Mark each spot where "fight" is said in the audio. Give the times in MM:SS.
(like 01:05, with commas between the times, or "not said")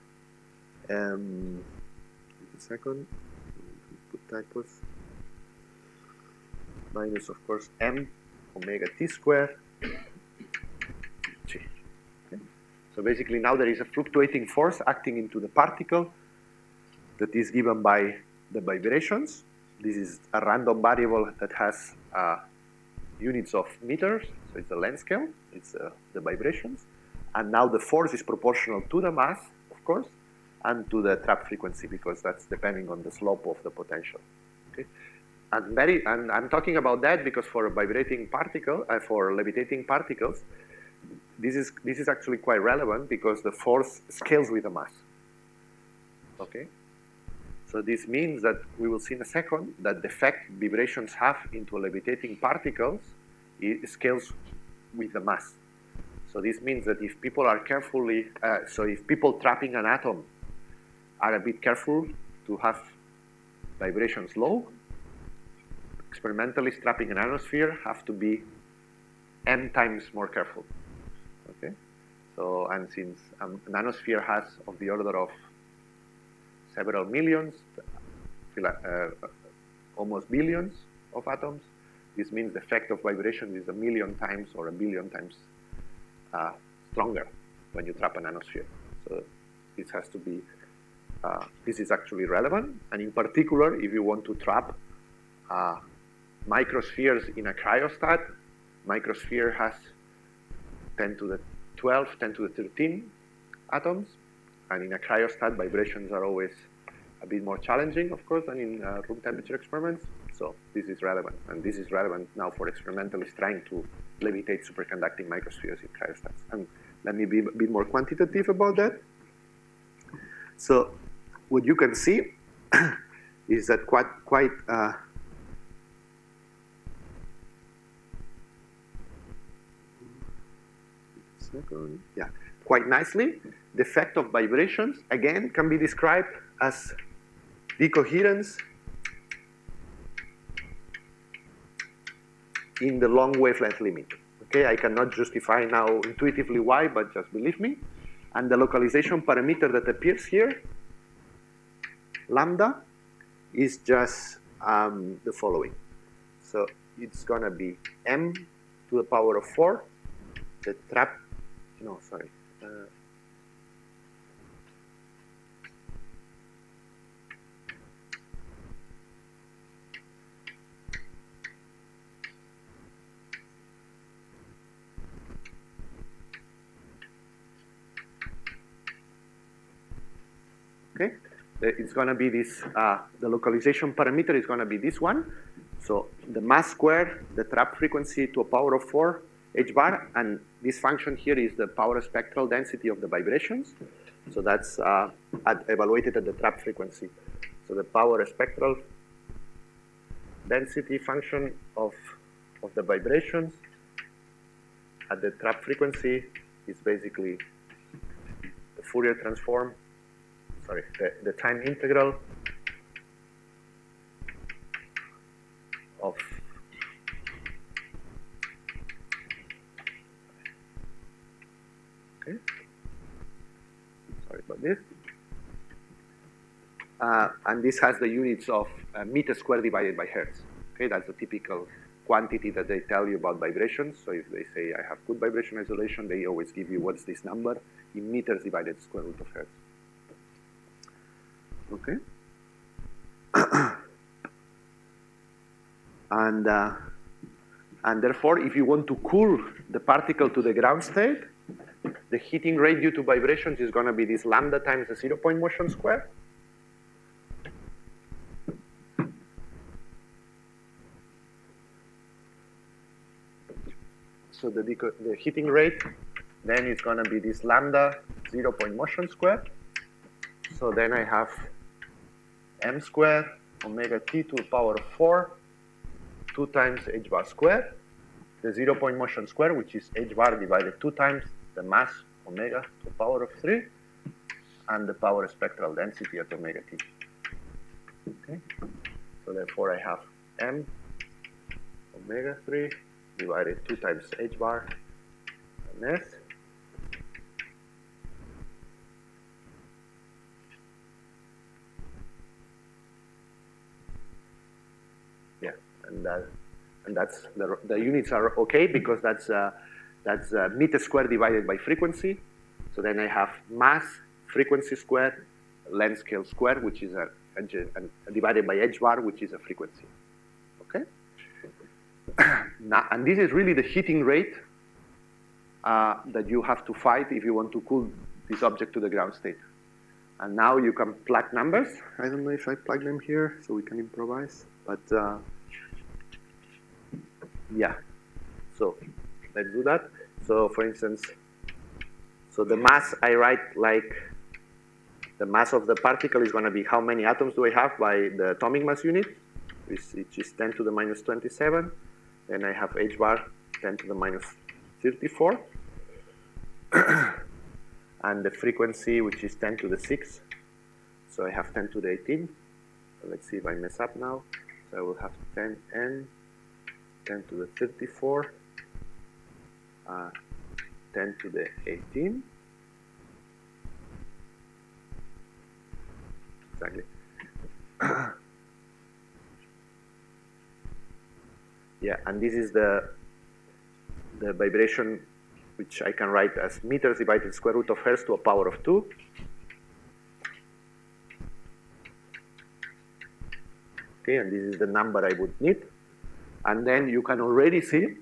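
05:26.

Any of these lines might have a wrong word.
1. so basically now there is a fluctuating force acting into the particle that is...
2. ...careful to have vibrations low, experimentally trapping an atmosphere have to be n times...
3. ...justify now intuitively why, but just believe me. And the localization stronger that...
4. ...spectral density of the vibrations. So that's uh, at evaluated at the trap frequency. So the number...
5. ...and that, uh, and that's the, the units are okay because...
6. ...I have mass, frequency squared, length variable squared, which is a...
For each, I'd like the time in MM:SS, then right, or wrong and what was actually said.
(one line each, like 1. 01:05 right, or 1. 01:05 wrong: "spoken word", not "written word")
1. 00:12 right
2. 01:01 right
3. 02:25 wrong: "parameter", not "stronger"
4. 03:12 wrong: "power", not "number"
5. 05:06 right
6. 05:12 wrong: "scale", not "variable".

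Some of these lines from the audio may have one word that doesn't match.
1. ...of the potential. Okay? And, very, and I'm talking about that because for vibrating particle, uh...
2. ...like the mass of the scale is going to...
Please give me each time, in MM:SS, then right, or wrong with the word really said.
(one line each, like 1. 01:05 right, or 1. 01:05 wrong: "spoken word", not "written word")
1. 00:33 right
2. 05:43 wrong: "particle", not "scale".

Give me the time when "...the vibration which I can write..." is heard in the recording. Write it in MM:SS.
06:24.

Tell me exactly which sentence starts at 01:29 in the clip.
So this has to be, uh, this is actually relevant.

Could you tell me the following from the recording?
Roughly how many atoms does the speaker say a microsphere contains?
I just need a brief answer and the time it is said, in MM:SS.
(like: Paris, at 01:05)
10^12 to 10^13, at 01:40.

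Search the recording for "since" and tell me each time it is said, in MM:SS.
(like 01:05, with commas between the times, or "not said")
01:12.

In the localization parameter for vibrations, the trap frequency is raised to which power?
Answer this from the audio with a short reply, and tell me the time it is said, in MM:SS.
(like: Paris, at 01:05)
4, at 03:07.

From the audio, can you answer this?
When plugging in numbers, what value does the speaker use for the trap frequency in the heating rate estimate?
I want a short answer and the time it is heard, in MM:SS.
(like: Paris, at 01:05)
10^6, at 05:59.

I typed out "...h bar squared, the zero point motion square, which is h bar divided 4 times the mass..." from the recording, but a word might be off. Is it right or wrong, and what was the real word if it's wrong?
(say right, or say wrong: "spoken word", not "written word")
wrong: "2", not "4".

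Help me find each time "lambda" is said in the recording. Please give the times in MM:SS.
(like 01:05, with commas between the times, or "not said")
02:32, 04:14, 04:27.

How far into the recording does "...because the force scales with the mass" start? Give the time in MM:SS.
00:43.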